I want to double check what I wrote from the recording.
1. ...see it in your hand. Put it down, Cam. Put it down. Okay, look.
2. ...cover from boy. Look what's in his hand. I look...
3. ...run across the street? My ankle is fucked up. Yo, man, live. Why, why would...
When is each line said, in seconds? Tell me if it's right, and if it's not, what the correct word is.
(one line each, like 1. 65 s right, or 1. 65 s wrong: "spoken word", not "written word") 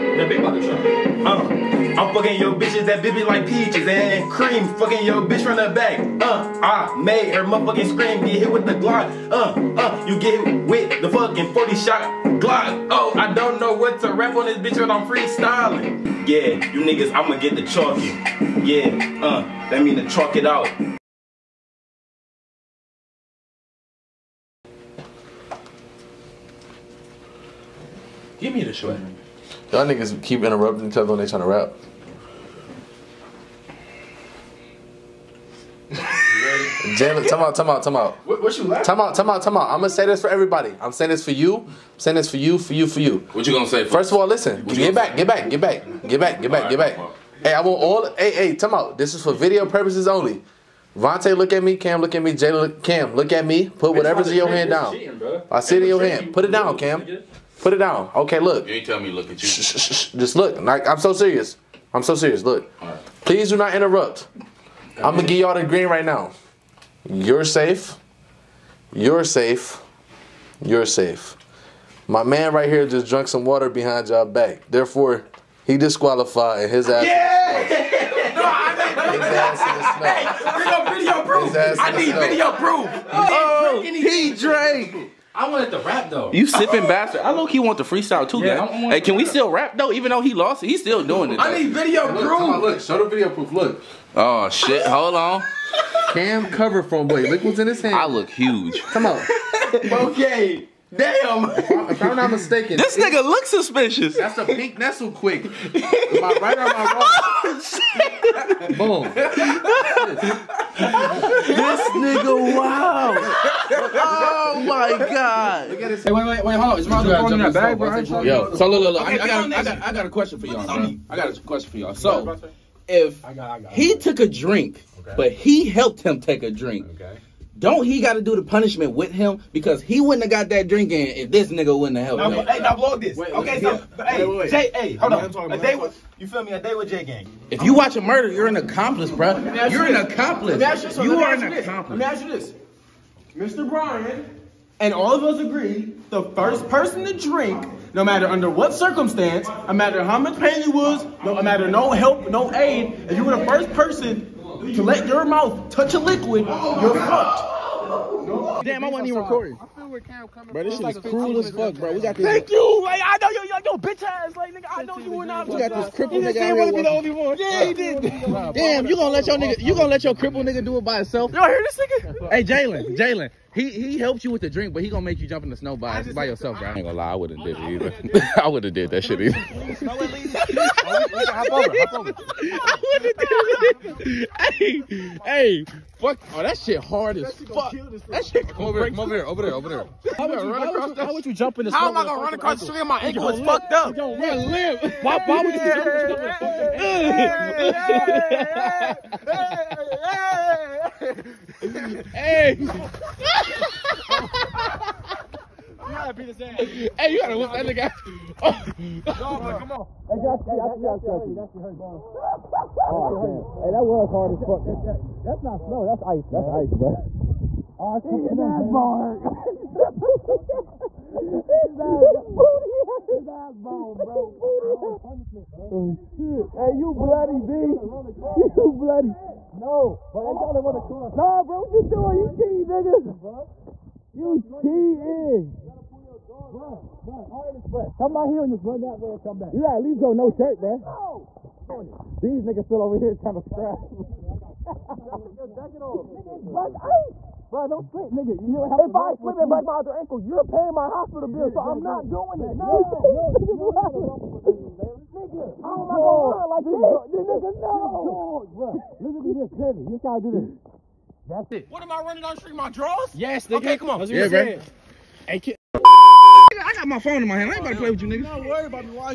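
1. 55 s right
2. 96 s right
3. 192 s right.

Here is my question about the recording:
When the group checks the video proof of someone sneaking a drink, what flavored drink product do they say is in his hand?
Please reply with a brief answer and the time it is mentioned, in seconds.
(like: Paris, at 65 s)
Pink Nestlé Quik, at 104 s.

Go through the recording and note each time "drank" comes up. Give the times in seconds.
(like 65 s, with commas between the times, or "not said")
73 s, 84 s.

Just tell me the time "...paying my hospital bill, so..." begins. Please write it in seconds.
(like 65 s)
250 s.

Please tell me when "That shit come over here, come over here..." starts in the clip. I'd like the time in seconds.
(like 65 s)
188 s.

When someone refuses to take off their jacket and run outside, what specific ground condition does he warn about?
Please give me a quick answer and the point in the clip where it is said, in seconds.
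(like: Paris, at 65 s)
Black ice, at 246 s.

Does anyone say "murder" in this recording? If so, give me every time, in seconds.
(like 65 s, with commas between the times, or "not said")
138 s.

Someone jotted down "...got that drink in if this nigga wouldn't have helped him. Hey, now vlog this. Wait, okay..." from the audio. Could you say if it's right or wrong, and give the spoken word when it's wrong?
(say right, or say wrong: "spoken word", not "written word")
right.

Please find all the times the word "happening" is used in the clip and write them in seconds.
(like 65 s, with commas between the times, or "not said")
not said.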